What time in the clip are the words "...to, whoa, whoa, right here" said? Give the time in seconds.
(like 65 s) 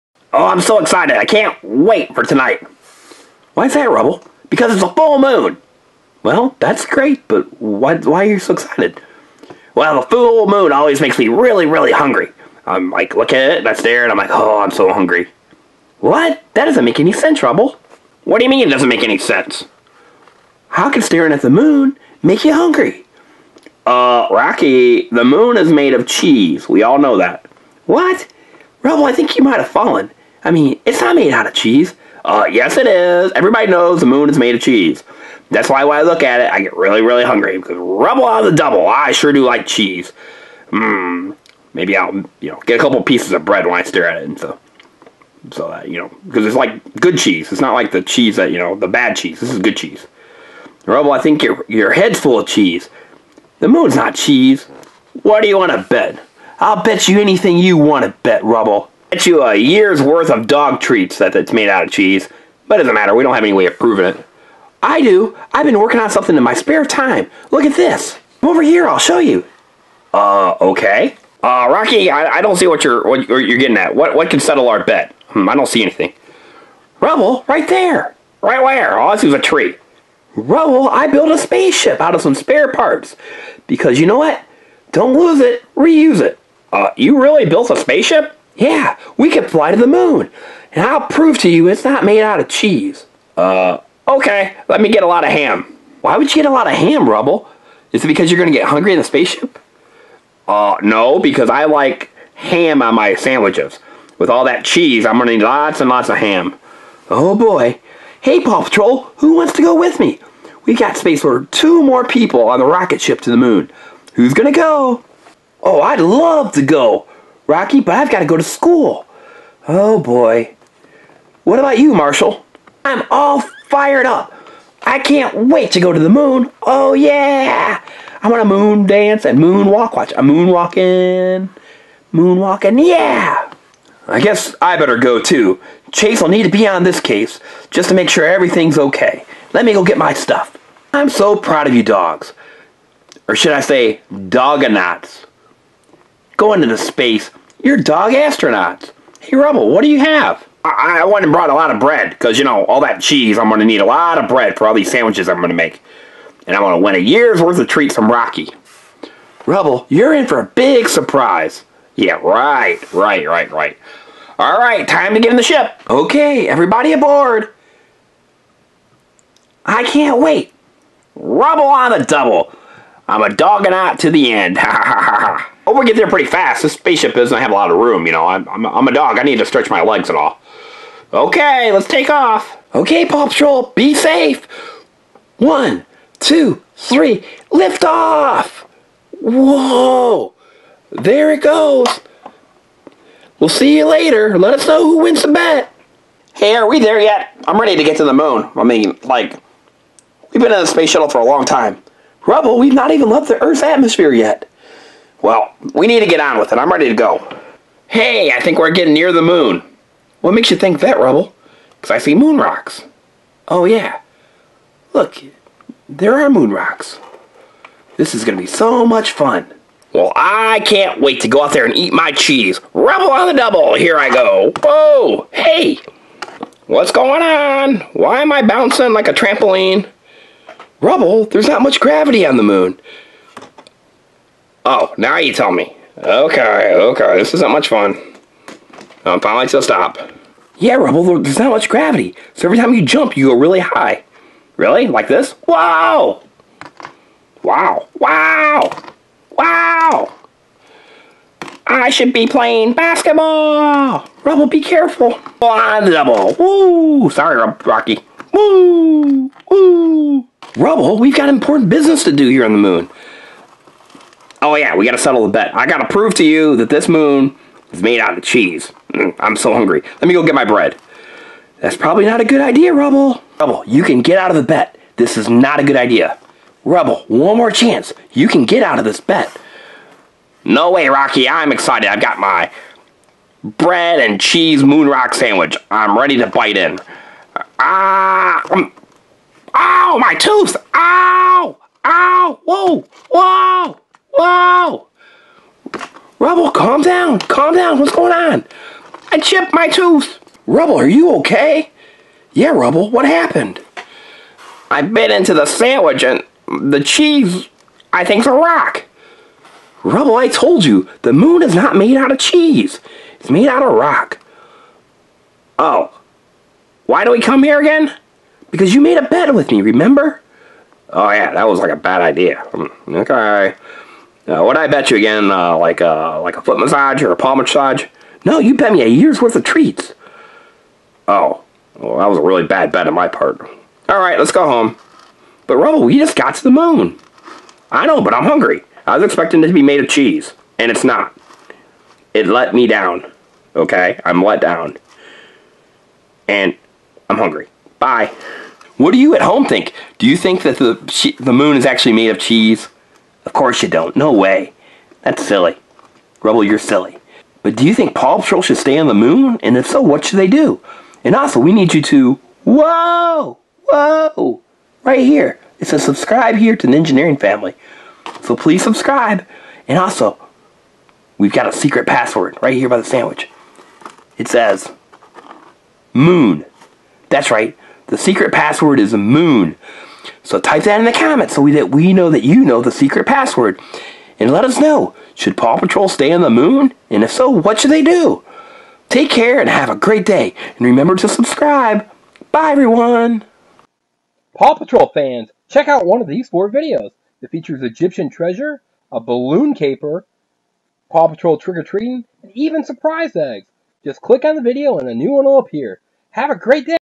361 s.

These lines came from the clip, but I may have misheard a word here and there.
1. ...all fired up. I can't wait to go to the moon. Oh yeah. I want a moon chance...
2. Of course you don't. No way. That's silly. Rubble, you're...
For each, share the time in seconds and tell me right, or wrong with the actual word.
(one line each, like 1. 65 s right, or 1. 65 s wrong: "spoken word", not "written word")
1. 123 s wrong: "dance", not "chance"
2. 353 s right.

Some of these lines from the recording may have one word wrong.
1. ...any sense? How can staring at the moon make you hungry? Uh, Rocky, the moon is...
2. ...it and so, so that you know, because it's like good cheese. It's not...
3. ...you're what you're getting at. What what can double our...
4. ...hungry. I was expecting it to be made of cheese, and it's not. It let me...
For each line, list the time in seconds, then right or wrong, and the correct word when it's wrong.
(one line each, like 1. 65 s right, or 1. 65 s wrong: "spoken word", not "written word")
1. 19 s right
2. 44 s right
3. 72 s wrong: "settle", not "double"
4. 338 s right.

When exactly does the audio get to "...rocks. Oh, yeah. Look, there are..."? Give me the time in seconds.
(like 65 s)
212 s.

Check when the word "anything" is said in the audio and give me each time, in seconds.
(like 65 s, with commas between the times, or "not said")
57 s, 75 s.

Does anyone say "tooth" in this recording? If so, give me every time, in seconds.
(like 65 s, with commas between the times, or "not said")
290 s, 299 s.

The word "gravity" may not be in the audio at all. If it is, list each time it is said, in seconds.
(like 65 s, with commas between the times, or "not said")
231 s, 241 s.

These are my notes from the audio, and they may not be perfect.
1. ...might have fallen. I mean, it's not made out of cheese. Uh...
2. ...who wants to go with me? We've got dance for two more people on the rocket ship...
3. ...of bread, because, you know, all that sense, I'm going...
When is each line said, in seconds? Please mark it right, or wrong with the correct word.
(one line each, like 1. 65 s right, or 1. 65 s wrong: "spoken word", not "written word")
1. 29 s right
2. 109 s wrong: "space", not "dance"
3. 151 s wrong: "cheese", not "sense".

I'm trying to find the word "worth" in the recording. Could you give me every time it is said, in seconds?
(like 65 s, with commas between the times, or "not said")
60 s, 157 s, 329 s.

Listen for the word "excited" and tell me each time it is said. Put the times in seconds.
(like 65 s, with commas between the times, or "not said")
0 s, 8 s, 281 s.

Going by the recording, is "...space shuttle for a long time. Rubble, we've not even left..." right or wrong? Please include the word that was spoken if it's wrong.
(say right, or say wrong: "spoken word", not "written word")
right.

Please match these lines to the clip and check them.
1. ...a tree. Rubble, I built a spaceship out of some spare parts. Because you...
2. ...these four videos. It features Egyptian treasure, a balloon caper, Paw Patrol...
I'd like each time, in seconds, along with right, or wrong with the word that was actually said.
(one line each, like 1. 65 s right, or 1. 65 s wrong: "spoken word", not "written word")
1. 79 s right
2. 396 s right.